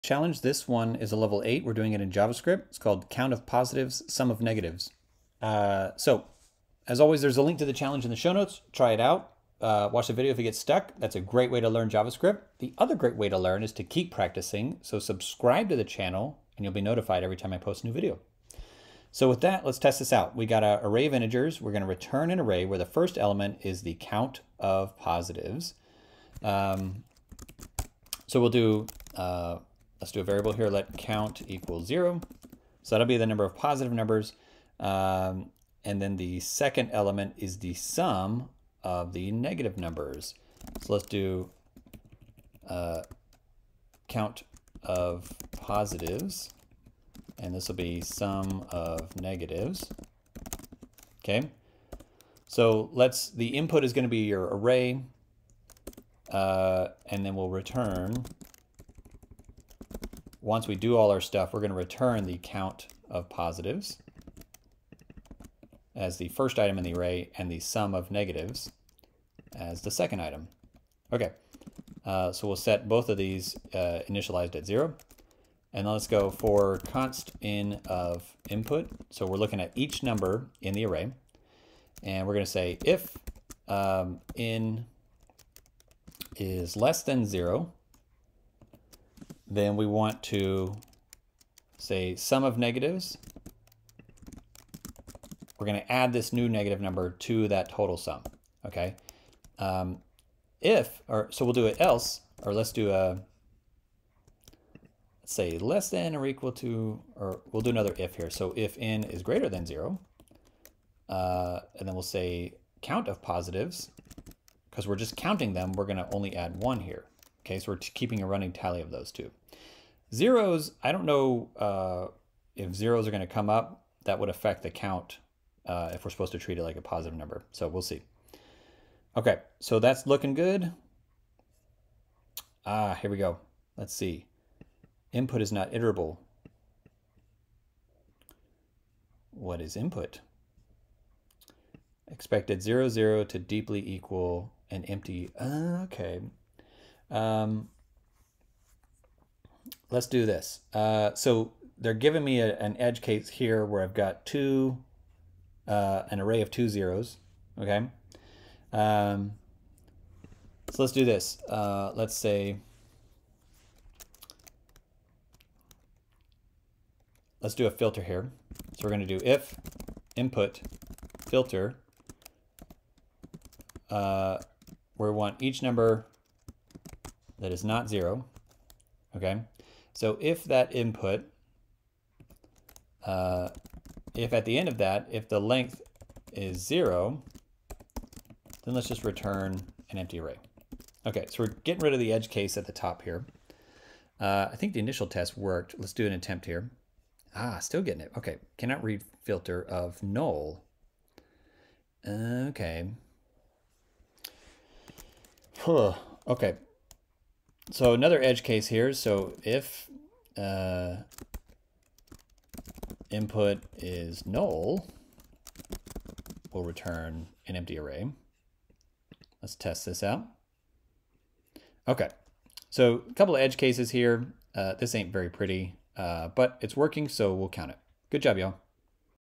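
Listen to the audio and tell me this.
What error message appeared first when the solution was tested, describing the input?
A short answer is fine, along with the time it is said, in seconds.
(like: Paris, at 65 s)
Input is not iterable, at 135 s.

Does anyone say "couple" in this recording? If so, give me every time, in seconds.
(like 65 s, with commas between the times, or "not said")
223 s.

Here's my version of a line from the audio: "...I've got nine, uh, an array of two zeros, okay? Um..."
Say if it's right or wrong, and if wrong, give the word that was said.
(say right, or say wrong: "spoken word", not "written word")
wrong: "two", not "nine".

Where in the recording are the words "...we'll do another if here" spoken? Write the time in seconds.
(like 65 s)
107 s.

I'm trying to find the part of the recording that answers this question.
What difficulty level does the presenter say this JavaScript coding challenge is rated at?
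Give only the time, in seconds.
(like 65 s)
1 s.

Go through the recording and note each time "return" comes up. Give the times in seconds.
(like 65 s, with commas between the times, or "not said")
21 s, 57 s, 61 s, 189 s, 216 s.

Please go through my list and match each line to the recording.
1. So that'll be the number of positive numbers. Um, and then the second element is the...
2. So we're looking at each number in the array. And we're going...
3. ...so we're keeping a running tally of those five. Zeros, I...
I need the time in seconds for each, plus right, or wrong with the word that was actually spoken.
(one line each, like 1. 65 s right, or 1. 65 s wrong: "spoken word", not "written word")
1. 32 s right
2. 79 s right
3. 117 s wrong: "two", not "five".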